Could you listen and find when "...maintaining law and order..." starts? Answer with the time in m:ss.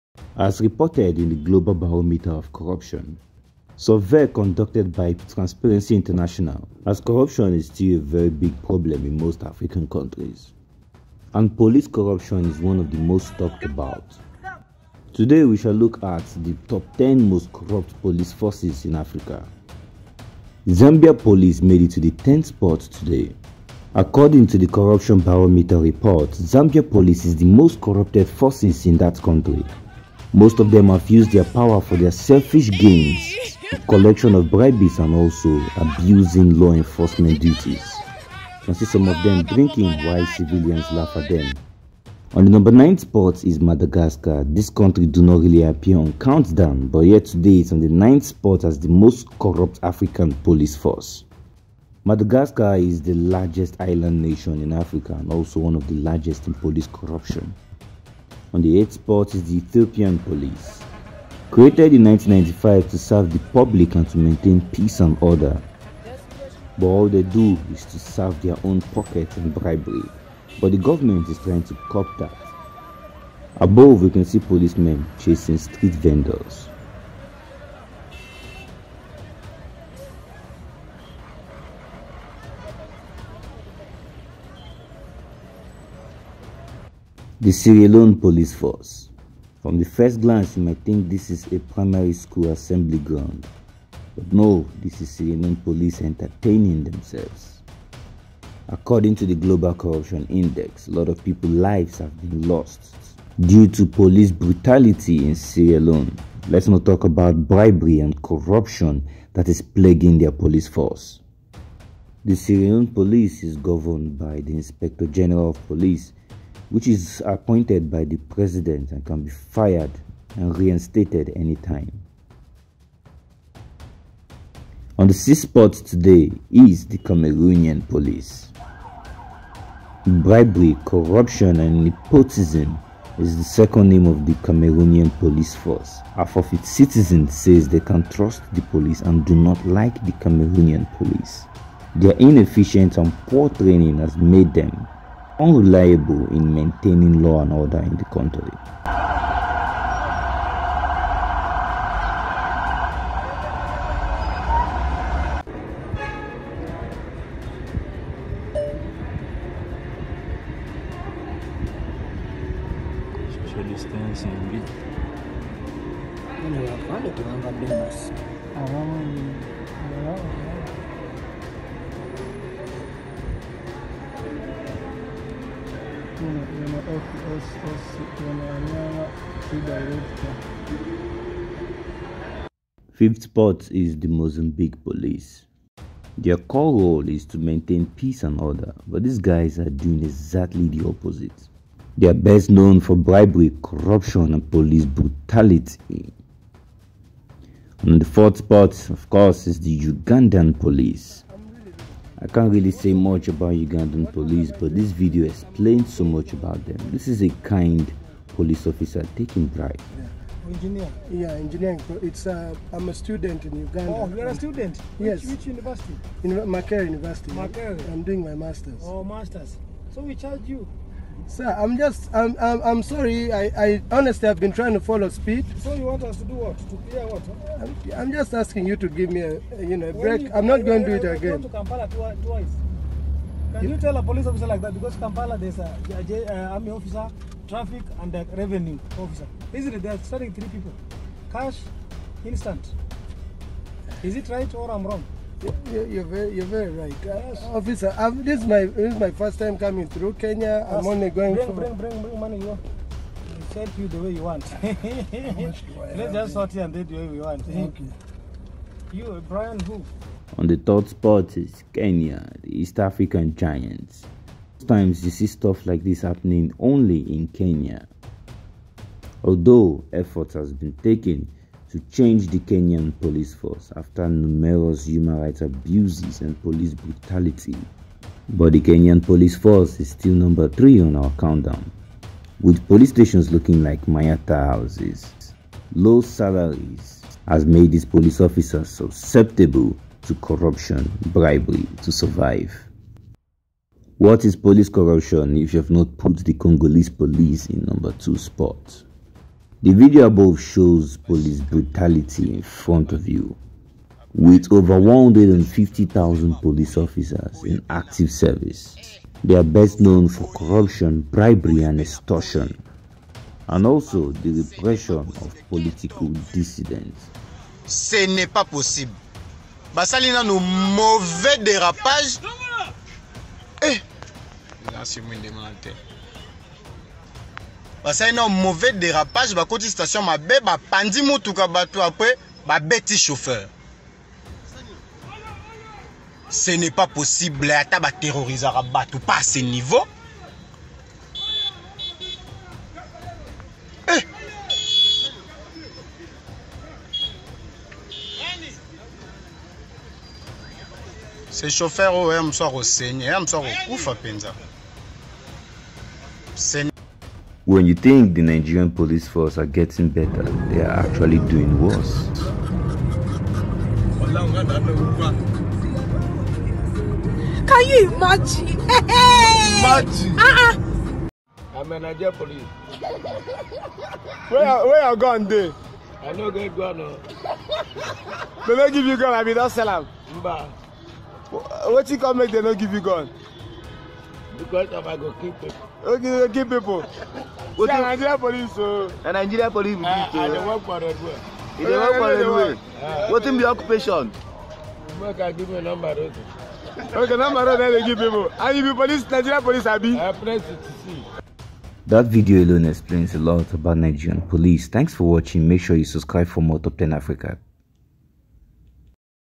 2:26.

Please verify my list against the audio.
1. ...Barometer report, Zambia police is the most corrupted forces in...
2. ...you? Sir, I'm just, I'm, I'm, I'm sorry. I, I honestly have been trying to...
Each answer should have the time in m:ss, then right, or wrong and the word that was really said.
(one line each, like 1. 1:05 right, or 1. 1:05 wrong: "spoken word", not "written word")
1. 0:25 right
2. 3:40 right.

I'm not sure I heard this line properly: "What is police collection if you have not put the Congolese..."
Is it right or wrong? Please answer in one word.
wrong.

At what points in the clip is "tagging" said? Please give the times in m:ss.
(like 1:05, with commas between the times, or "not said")
not said.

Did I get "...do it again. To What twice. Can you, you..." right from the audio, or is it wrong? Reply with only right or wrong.
wrong.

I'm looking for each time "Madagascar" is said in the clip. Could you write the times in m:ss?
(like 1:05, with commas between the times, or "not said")
0:43, 0:52.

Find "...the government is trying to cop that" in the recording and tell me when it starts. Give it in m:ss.
1:10.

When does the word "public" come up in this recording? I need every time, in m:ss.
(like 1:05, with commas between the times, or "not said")
1:03.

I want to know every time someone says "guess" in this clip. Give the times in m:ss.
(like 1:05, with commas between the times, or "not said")
not said.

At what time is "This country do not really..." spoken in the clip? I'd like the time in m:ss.
0:44.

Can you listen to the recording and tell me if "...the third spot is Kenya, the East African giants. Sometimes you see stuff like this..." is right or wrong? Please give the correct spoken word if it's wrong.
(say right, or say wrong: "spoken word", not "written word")
right.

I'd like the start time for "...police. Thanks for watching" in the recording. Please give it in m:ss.
6:44.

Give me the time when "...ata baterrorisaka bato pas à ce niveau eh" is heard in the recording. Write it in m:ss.
5:37.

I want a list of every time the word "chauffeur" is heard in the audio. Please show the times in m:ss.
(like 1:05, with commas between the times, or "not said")
5:32, 5:51.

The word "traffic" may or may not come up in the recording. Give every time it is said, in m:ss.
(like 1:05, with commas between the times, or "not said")
3:57.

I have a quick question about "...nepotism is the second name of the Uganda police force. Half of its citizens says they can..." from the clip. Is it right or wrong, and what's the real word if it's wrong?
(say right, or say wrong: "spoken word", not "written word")
wrong: "Cameroonian", not "Uganda".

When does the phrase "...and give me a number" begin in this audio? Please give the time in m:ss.
6:35.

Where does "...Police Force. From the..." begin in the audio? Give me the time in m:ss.
1:28.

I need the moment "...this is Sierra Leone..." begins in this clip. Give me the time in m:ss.
1:34.